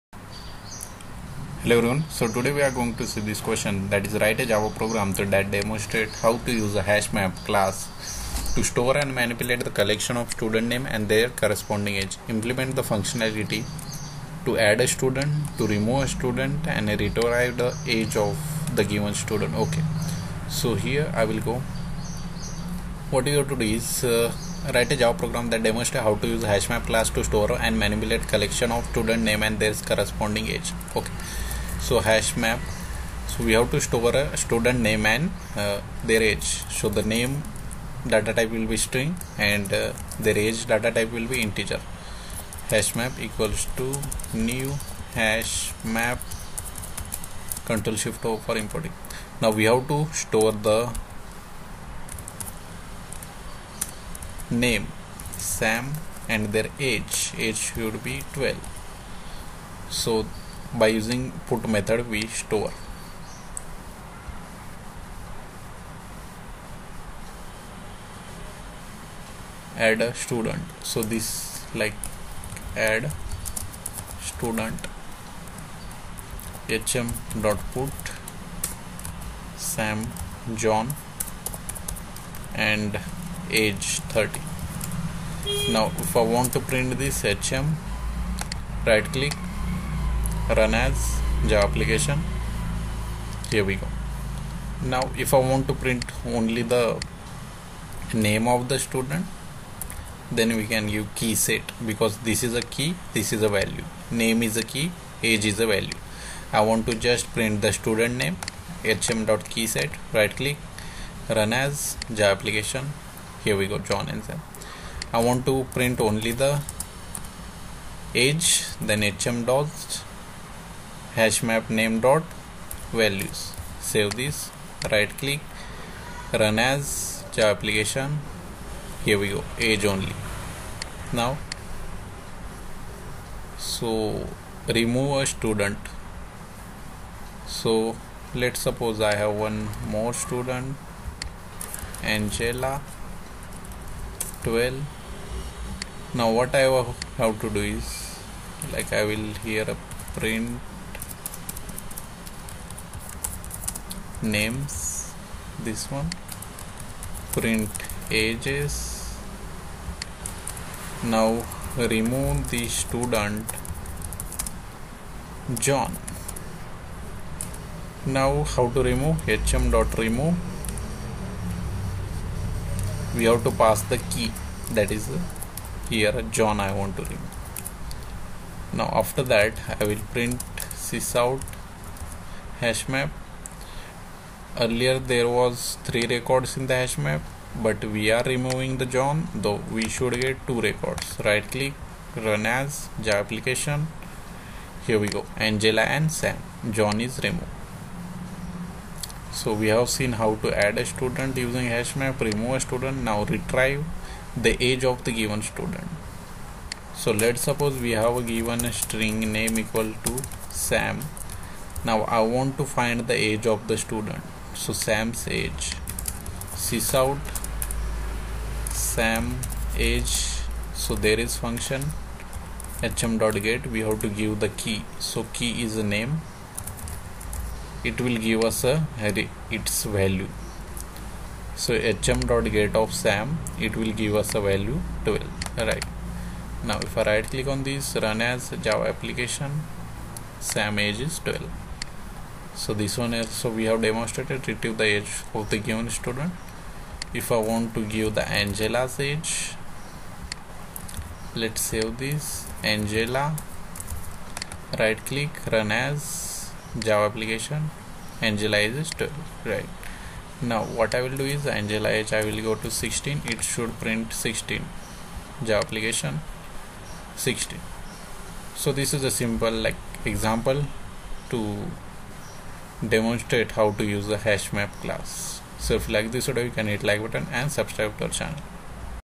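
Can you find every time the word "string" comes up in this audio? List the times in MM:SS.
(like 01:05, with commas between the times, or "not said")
00:38, 03:28.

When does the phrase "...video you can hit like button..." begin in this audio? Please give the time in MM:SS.
04:36.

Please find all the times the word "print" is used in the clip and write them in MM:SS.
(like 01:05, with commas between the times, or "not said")
01:26, 01:35, 01:47, 01:55, 02:30, 02:37, 03:00, 04:23.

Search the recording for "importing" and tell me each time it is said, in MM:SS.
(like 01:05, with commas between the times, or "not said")
00:48.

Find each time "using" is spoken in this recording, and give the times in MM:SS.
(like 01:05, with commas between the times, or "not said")
01:00, 03:21.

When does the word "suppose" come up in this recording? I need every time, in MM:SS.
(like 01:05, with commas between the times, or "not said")
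02:18, 03:27.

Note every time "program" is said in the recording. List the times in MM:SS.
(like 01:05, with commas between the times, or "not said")
00:04, 00:25.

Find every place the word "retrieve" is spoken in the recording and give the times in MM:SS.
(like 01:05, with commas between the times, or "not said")
00:16, 03:23, 04:04.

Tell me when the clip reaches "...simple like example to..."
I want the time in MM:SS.
04:29.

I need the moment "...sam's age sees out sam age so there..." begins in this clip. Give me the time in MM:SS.
03:34.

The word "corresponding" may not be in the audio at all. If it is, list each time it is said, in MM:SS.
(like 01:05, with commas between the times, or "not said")
00:11, 00:29.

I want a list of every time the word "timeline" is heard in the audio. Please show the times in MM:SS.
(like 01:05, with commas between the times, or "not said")
not said.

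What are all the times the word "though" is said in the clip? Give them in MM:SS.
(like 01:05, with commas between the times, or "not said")
03:09.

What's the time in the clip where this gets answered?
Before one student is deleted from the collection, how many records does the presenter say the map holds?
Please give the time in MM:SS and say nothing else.
03:05.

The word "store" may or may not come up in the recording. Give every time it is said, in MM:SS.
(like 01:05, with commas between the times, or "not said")
00:08, 00:27, 00:33, 00:50, 01:02.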